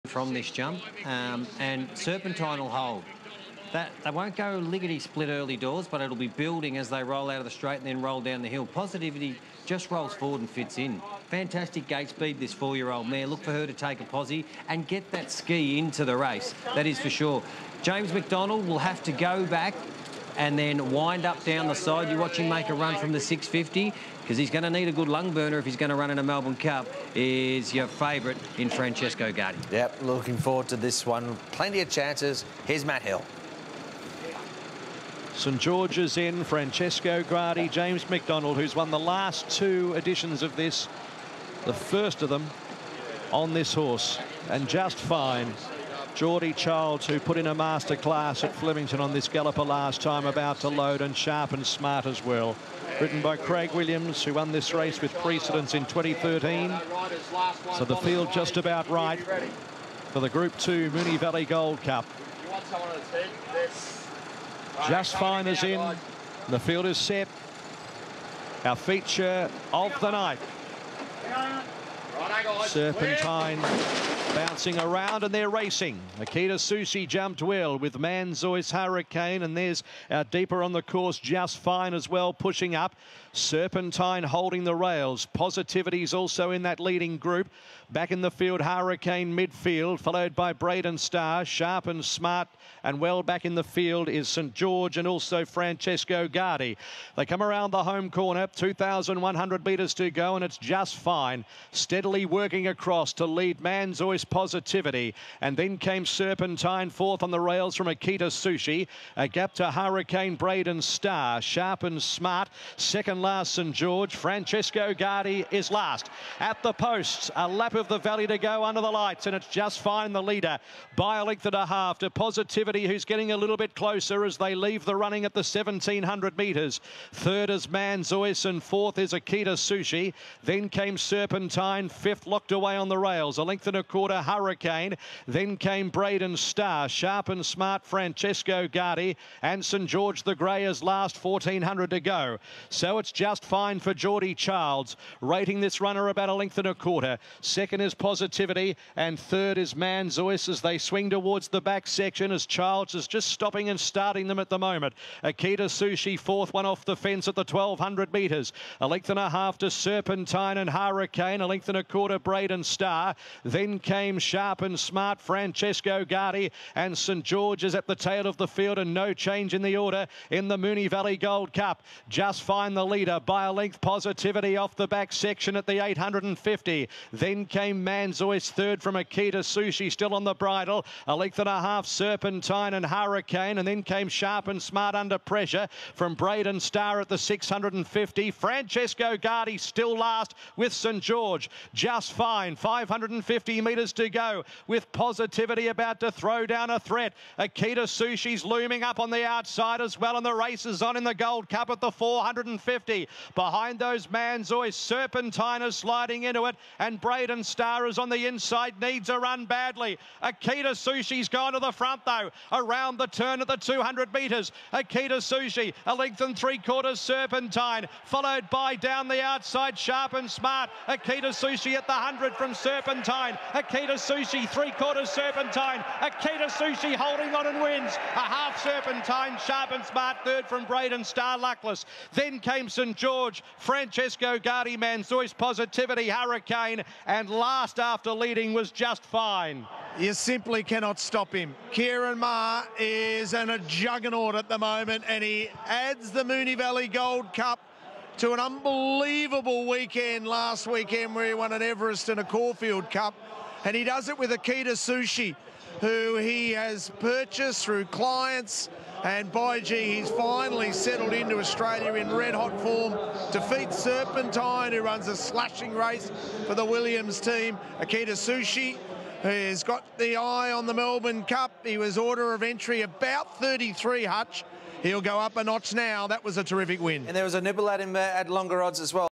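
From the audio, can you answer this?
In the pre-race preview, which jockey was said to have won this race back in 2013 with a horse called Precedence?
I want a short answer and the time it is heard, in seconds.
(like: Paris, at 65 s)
Craig Williams, at 53 s.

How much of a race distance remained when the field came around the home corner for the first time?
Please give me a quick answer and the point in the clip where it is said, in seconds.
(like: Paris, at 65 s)
2,100 metres, at 98 s.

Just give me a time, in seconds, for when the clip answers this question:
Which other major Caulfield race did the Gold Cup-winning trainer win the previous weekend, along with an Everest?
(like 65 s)
252 s.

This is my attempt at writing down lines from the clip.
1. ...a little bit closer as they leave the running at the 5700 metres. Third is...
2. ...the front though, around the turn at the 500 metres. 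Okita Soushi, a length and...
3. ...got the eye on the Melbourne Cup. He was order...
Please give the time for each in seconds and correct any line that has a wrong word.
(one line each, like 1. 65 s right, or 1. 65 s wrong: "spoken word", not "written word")
1. 123 s wrong: "1700", not "5700"
2. 211 s wrong: "200", not "500"
3. 269 s right.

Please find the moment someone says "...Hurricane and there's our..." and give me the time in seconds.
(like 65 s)
78 s.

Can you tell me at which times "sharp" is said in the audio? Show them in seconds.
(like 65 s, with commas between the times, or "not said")
51 s, 91 s, 111 s, 136 s, 164 s, 184 s, 219 s, 229 s.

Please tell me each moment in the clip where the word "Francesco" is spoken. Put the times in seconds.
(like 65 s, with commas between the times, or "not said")
28 s, 36 s, 95 s, 114 s, 137 s, 165 s, 188 s, 233 s.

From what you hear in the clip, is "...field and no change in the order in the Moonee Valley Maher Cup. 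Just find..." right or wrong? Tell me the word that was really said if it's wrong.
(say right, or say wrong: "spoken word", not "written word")
wrong: "Gold", not "Maher".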